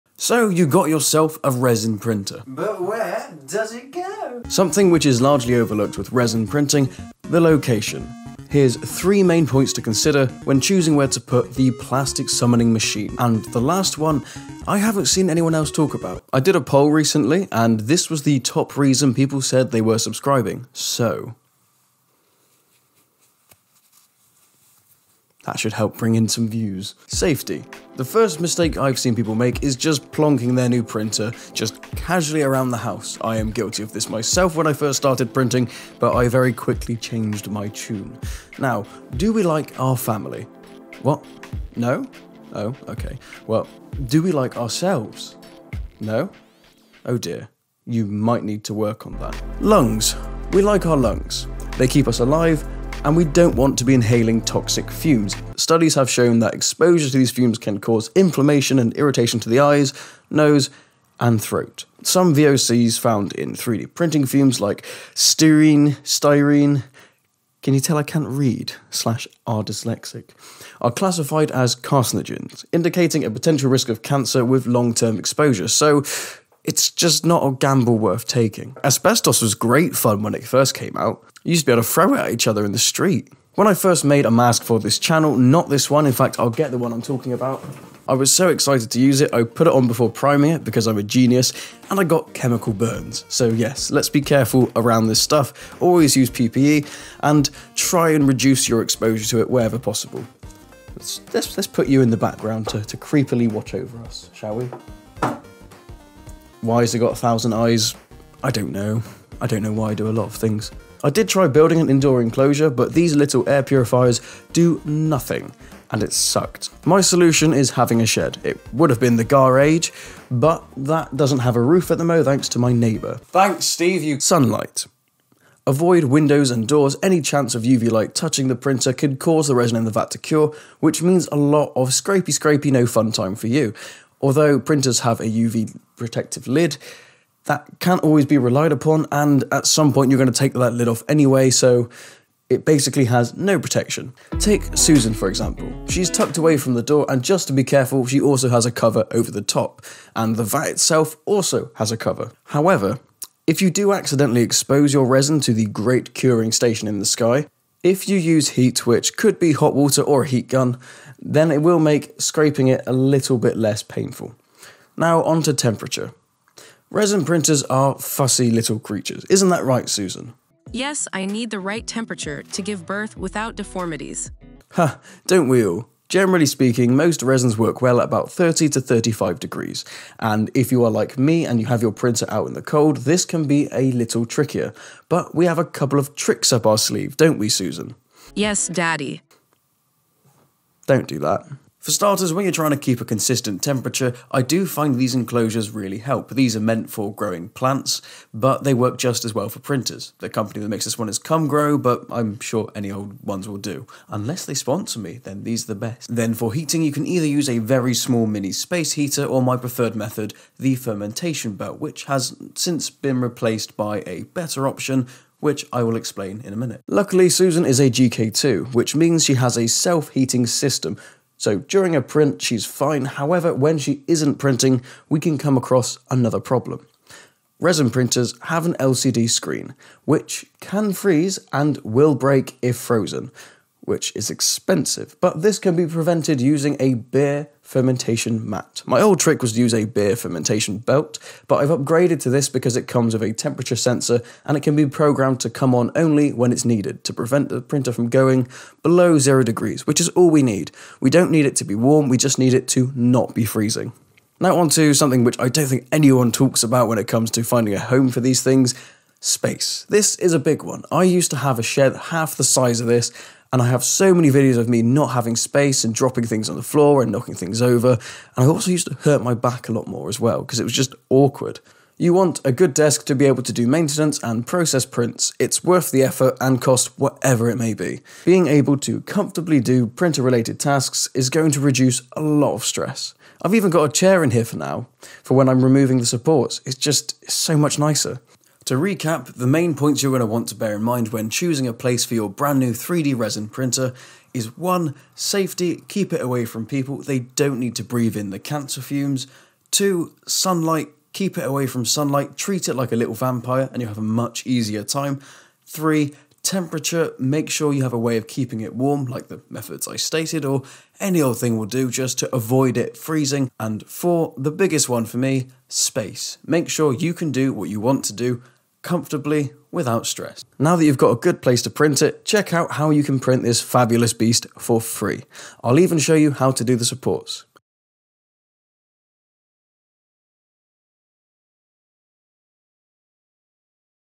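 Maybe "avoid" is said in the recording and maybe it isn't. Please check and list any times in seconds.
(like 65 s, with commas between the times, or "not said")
125 s, 312 s.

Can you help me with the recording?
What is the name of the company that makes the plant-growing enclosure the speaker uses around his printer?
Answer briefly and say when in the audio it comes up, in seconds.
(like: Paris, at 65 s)
Come Grow, at 201 s.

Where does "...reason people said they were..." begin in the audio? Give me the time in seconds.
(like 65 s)
18 s.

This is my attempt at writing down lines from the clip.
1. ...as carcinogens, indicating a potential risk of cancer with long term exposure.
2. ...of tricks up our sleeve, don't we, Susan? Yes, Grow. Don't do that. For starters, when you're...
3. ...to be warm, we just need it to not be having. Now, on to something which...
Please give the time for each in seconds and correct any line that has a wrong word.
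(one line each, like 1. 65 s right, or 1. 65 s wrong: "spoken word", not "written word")
1. 71 s right
2. 185 s wrong: "Daddy", not "Grow"
3. 251 s wrong: "freezing", not "having".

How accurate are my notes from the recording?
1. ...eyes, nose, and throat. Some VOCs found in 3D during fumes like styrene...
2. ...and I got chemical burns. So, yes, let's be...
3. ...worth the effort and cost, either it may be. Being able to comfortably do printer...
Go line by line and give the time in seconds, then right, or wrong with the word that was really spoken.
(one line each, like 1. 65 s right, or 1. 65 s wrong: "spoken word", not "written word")
1. 59 s wrong: "printing", not "during"
2. 91 s right
3. 275 s wrong: "whatever", not "either".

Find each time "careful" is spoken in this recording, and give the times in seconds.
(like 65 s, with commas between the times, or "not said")
94 s, 147 s.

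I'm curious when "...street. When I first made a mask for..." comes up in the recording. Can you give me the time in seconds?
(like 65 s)
82 s.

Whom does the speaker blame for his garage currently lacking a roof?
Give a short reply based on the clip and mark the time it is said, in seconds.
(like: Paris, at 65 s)
Steve, at 123 s.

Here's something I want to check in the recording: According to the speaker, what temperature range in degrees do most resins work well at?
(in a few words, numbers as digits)
30 to 35.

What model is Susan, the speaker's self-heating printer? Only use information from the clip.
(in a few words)
GK2.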